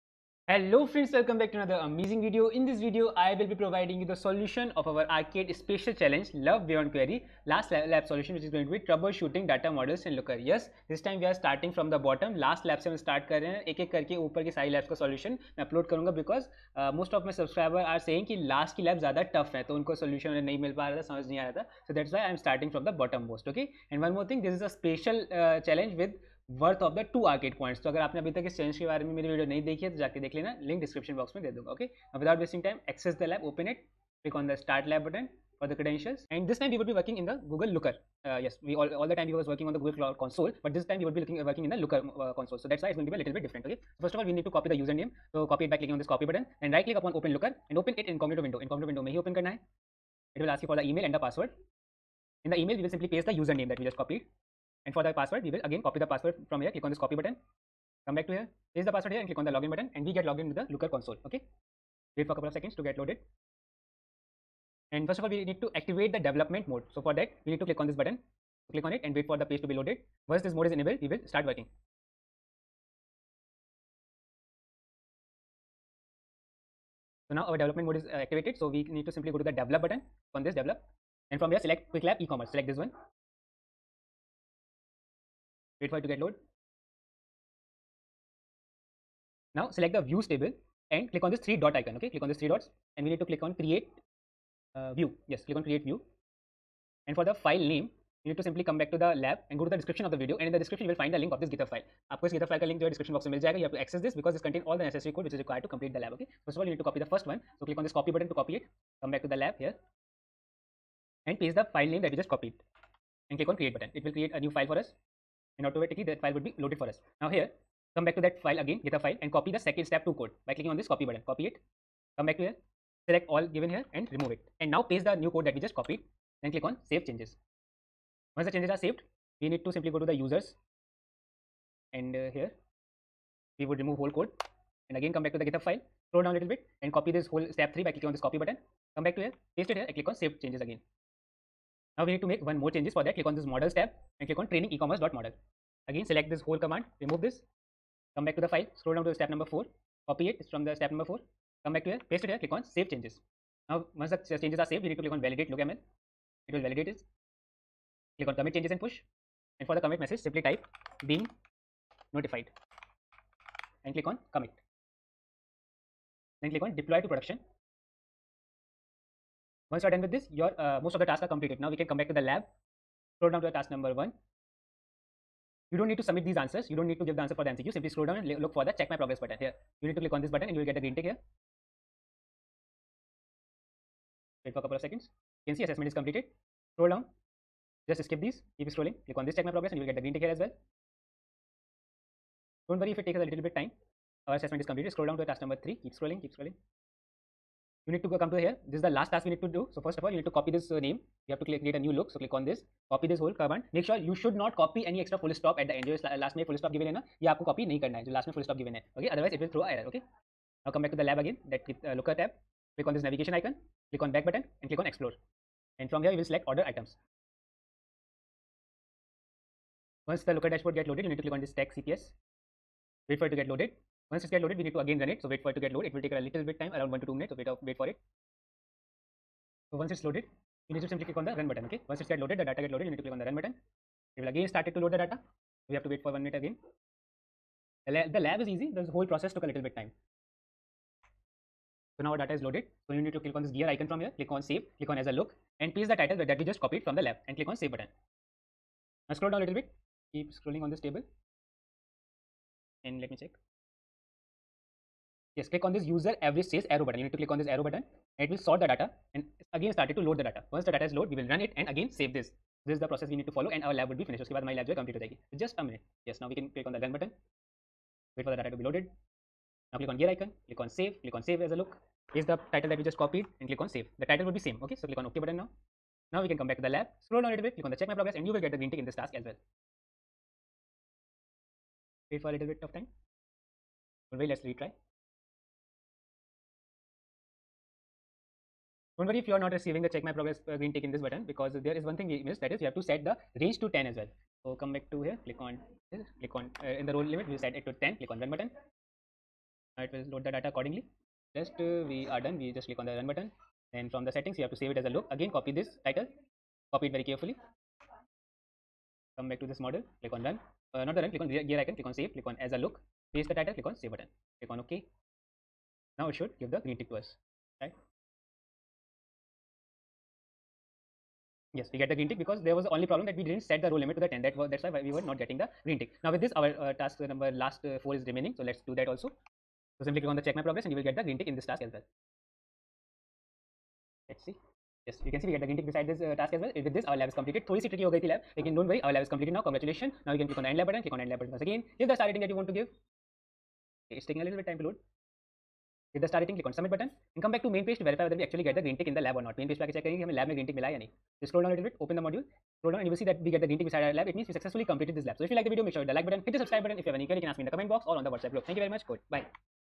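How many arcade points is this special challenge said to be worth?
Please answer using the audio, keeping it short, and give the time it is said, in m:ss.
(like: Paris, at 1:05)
2, at 0:27.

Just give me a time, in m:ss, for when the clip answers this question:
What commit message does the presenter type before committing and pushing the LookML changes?
2:41.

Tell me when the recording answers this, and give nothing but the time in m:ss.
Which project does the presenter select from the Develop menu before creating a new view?
1:21.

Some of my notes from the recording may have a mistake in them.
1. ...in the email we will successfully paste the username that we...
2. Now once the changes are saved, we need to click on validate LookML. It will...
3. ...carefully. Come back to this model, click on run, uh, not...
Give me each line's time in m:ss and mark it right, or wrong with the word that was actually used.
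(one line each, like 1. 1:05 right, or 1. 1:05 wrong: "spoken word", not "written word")
1. 0:52 wrong: "simply", not "successfully"
2. 2:33 right
3. 5:07 right.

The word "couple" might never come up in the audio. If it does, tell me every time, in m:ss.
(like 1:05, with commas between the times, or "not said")
1:02, 3:04.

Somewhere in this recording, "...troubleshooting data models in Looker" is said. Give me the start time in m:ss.
0:08.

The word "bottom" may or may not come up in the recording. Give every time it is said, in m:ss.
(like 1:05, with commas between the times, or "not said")
0:12, 0:23.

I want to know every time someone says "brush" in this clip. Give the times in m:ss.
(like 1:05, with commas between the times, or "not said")
not said.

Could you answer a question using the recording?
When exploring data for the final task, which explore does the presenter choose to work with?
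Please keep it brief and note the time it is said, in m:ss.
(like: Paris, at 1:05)
order items, at 3:36.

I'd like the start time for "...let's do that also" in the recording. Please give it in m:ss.
5:28.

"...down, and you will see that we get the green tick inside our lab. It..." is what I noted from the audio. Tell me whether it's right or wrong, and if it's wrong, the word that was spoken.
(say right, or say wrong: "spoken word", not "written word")
right.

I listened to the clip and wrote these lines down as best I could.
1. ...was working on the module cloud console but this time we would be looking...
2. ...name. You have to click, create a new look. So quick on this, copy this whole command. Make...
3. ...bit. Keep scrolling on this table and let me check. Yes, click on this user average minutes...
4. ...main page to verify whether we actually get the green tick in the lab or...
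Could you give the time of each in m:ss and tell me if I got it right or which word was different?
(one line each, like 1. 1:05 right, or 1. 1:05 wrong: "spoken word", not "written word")
1. 0:39 wrong: "google", not "module"
2. 3:20 wrong: "click", not "quick"
3. 4:09 wrong: "sales", not "minutes"
4. 5:47 right.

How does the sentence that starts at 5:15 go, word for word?
Now it should give the green tick to us, right?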